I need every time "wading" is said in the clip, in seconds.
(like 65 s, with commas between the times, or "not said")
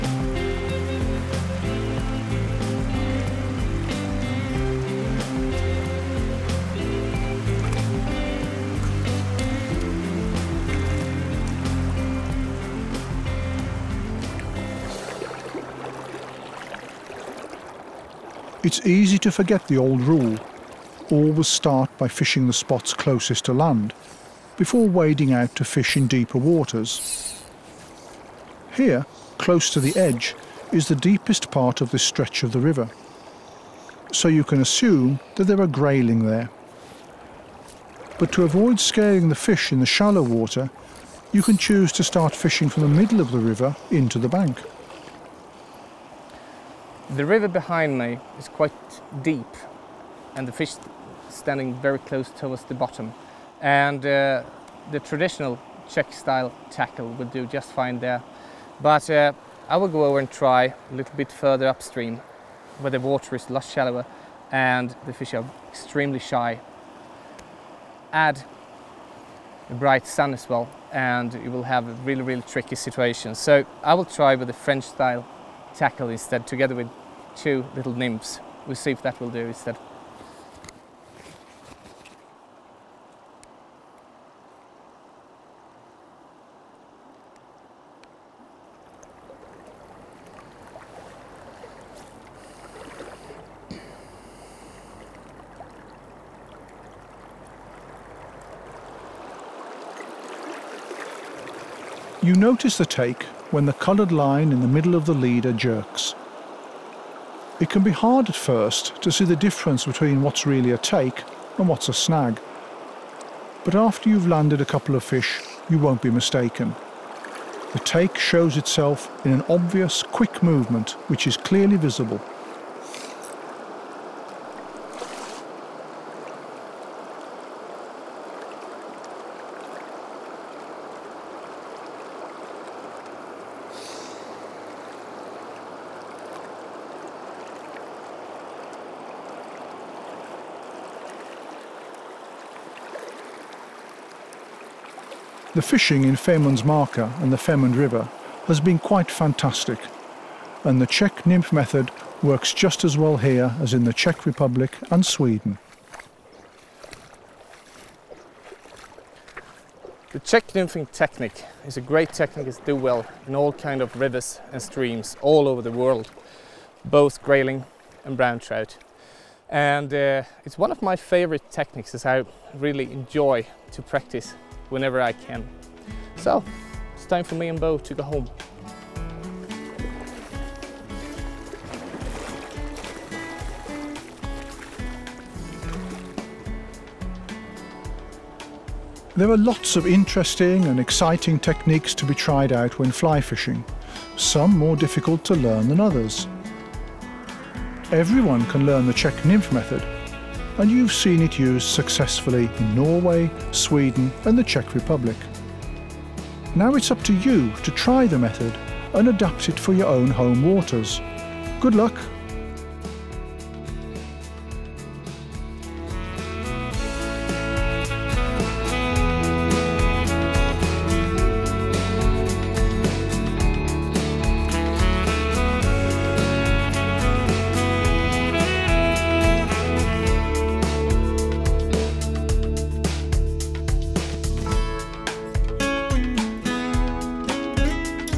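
24 s.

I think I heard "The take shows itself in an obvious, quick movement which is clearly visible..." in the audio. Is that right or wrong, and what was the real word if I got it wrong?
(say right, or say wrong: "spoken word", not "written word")
right.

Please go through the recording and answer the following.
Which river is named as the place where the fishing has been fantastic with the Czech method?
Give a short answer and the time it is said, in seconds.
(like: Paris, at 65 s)
Femund River, at 147 s.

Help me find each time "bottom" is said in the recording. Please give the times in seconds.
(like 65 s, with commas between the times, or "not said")
52 s.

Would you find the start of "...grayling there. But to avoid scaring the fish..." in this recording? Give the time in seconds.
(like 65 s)
35 s.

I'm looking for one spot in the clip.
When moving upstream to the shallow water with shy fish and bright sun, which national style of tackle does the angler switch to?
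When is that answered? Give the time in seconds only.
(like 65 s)
74 s.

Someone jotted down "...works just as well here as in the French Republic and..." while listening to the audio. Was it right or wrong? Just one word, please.
wrong.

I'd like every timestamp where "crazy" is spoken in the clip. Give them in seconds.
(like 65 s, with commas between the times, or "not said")
not said.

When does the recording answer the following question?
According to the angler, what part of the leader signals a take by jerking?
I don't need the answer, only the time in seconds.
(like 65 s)
103 s.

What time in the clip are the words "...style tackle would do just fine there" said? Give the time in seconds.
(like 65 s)
56 s.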